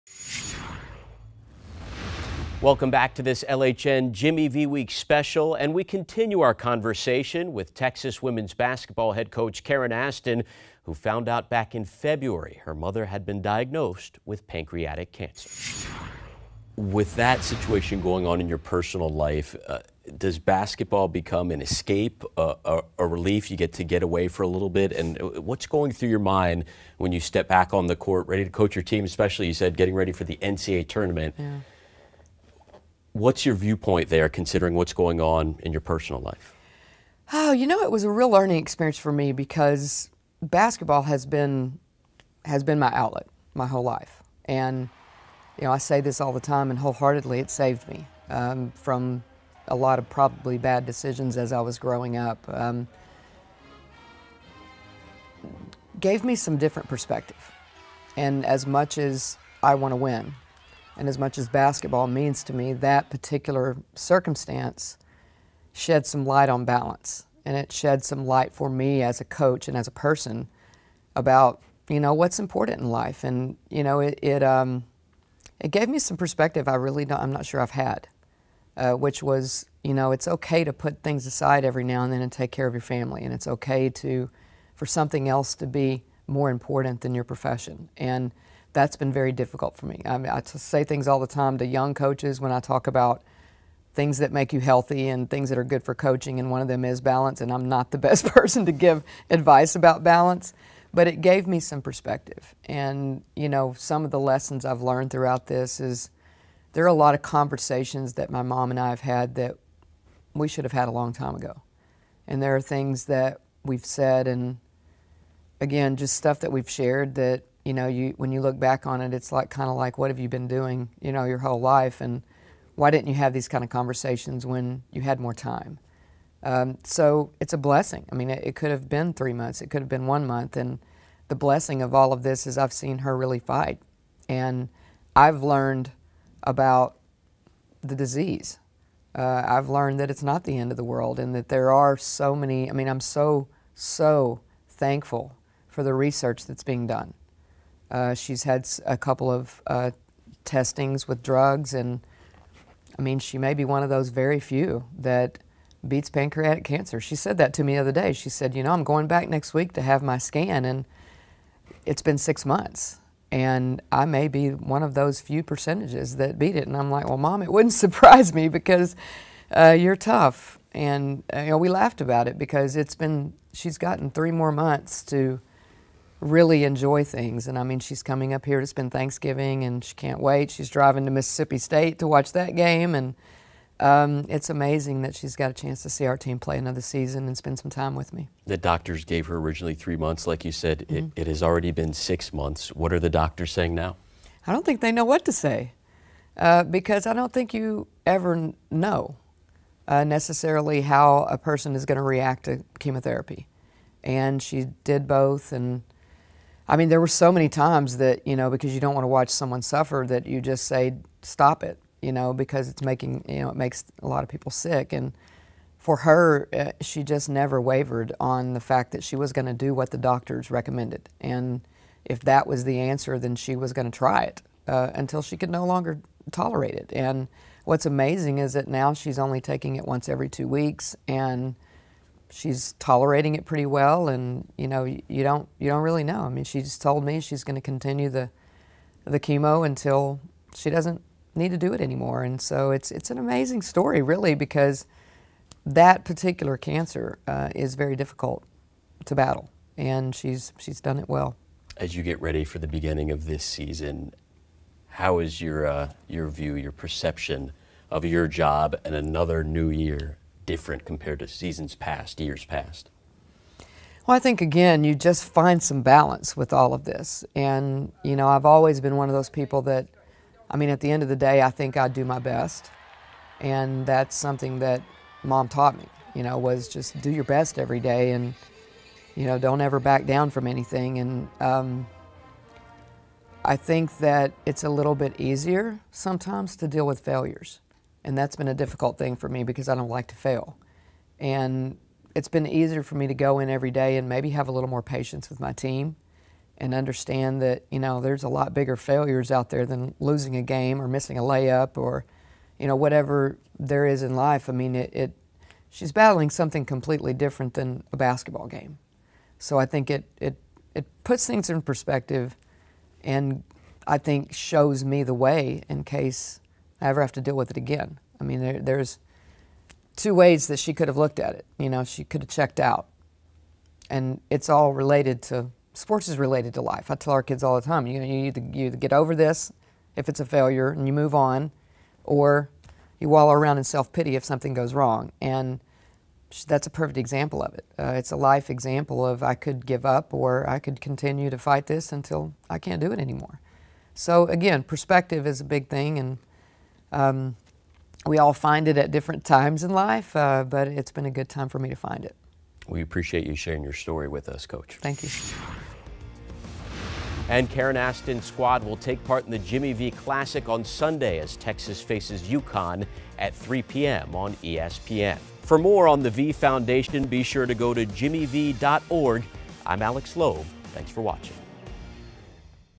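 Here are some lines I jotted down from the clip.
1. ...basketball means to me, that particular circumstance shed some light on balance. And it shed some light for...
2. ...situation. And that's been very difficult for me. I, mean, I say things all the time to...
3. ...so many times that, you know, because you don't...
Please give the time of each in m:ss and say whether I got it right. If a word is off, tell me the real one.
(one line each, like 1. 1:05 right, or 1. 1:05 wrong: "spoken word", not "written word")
1. 1:01 right
2. 1:27 wrong: "profession", not "situation"
3. 3:27 right.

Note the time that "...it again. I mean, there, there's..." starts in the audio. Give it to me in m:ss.
5:17.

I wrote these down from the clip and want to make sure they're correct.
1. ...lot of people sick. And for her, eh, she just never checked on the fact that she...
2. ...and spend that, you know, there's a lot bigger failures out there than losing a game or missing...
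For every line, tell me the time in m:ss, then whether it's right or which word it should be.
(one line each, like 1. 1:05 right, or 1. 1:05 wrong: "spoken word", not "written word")
1. 3:34 wrong: "wavered", not "checked"
2. 4:56 wrong: "understand", not "spend".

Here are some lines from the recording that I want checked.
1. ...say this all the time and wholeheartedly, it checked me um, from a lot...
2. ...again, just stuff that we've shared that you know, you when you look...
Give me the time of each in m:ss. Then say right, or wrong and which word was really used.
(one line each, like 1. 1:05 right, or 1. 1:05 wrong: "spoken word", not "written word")
1. 0:45 wrong: "saved", not "checked"
2. 1:55 right.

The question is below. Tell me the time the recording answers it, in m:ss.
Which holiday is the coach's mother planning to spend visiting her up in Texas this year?
2:58.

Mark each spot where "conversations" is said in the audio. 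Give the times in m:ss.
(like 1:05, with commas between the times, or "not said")
0:06, 1:47, 2:03.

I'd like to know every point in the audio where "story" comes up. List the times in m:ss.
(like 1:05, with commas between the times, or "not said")
4:03, 5:53.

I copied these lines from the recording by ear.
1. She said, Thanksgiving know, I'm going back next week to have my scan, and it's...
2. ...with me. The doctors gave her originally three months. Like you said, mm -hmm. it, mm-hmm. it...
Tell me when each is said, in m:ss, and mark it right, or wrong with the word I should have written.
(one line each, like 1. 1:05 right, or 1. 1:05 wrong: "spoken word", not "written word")
1. 2:38 wrong: "You", not "Thanksgiving"
2. 3:07 right.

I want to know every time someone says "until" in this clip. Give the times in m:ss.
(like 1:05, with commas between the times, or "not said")
3:44, 3:59, 5:41.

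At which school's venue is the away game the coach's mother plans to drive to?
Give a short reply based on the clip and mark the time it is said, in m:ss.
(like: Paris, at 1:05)
Mississippi State, at 3:01.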